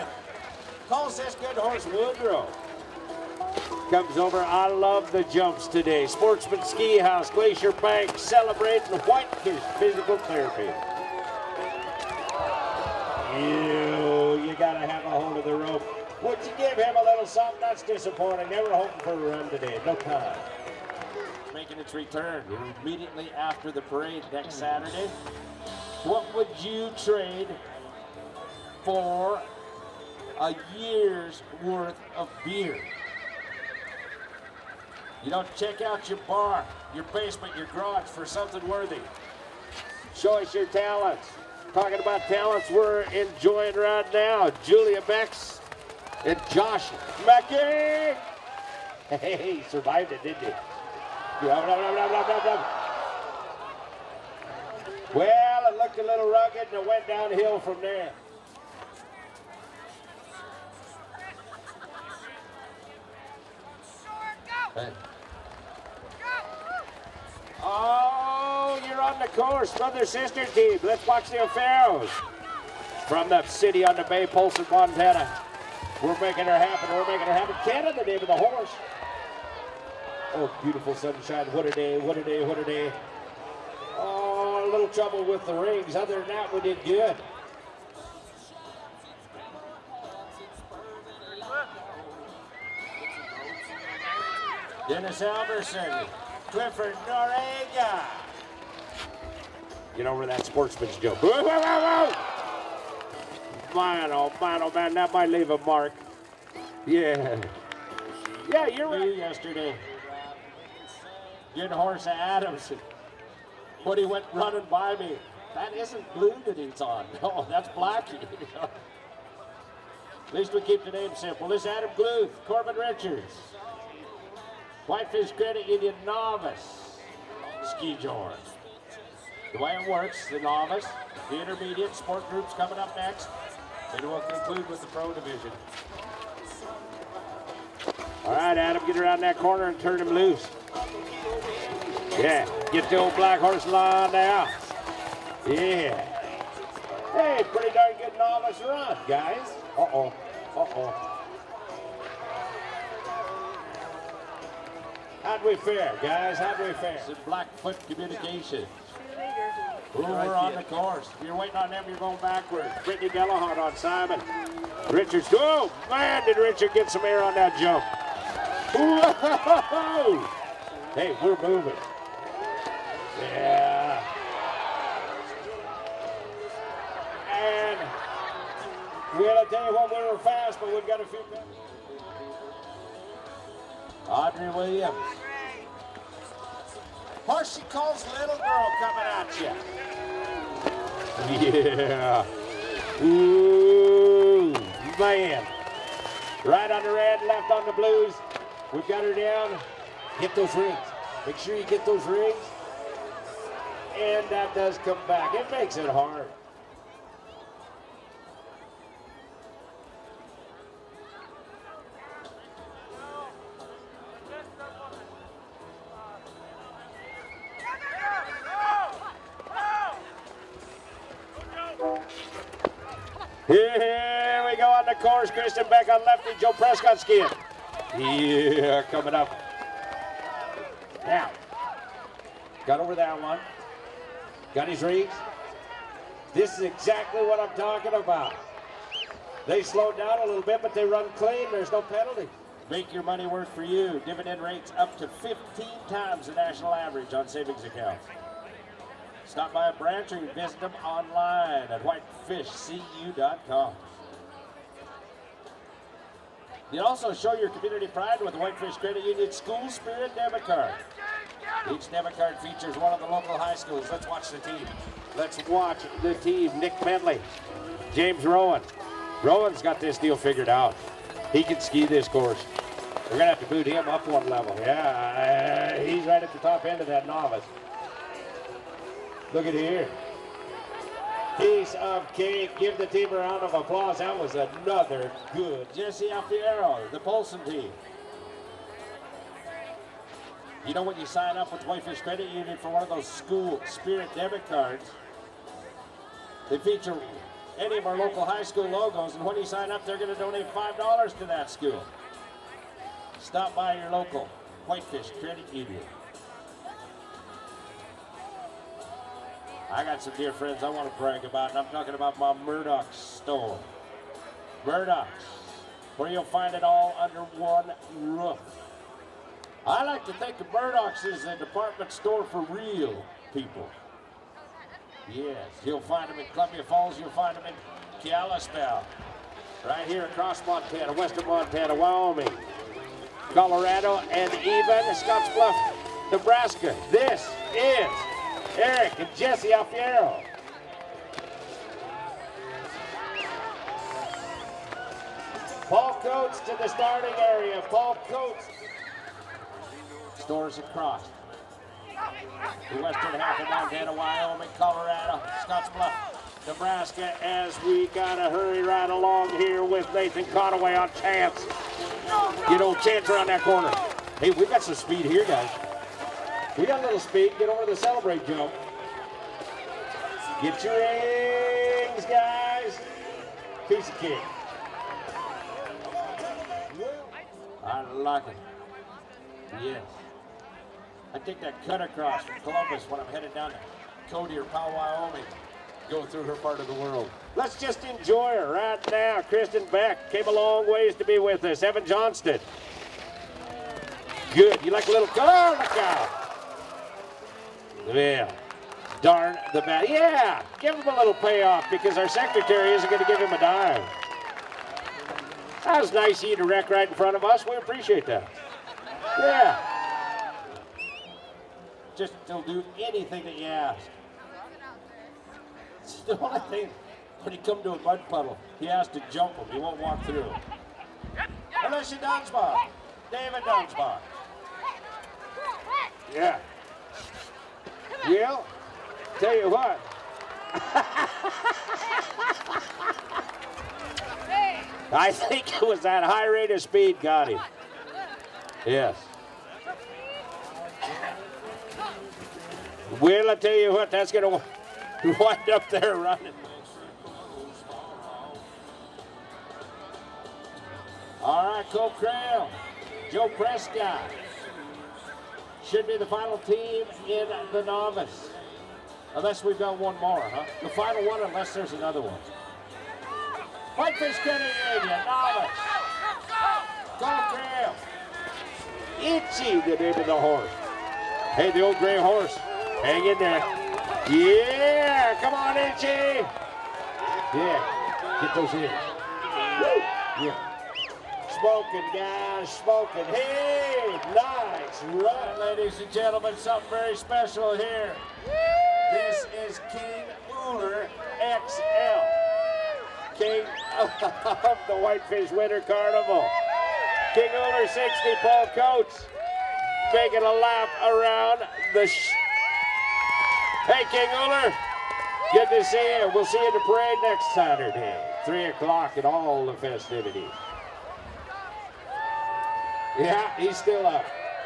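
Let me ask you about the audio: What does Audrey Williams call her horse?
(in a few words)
Little Girl.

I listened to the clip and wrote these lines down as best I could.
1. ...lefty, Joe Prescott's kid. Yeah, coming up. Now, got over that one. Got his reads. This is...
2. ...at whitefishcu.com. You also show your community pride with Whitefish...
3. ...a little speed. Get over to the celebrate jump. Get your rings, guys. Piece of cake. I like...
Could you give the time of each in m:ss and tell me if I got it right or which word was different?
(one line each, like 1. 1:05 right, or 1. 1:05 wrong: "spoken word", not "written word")
1. 3:46 right
2. 4:11 right
3. 6:06 right.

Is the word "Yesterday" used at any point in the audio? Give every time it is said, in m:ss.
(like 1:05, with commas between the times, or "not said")
1:49.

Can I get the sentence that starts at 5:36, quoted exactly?
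This is Eric and Jesse Alfiero.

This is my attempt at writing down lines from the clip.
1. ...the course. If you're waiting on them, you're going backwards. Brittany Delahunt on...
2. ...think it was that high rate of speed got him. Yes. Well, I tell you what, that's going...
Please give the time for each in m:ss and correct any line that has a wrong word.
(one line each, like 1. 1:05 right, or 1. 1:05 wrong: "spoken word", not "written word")
1. 2:40 right
2. 7:15 right.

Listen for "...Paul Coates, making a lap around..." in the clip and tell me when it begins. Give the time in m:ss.
8:18.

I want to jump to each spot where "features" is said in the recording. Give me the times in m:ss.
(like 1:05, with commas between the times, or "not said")
4:22, 4:56.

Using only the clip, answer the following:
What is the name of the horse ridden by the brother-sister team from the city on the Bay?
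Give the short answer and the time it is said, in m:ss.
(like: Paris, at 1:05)
Canada, at 1:17.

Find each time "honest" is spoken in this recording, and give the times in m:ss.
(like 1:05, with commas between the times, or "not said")
not said.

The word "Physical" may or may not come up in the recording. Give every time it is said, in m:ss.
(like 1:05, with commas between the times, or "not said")
0:09.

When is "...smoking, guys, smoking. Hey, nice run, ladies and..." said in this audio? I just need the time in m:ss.
8:01.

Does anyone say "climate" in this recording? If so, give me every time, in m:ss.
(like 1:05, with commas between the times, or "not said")
not said.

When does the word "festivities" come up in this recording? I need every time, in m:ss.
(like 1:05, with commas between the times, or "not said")
8:29.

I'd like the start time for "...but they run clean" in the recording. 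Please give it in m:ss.
4:00.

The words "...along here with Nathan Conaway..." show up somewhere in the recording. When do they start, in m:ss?
5:58.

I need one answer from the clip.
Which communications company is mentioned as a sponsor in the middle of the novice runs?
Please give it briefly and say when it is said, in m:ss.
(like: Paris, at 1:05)
Blackfoot Communications, at 2:37.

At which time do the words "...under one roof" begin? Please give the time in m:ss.
5:16.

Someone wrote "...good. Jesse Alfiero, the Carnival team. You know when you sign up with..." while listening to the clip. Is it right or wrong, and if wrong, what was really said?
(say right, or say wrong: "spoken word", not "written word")
wrong: "Polson", not "Carnival".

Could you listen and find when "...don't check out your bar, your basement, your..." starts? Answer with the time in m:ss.
0:35.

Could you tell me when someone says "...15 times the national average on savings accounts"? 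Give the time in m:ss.
4:05.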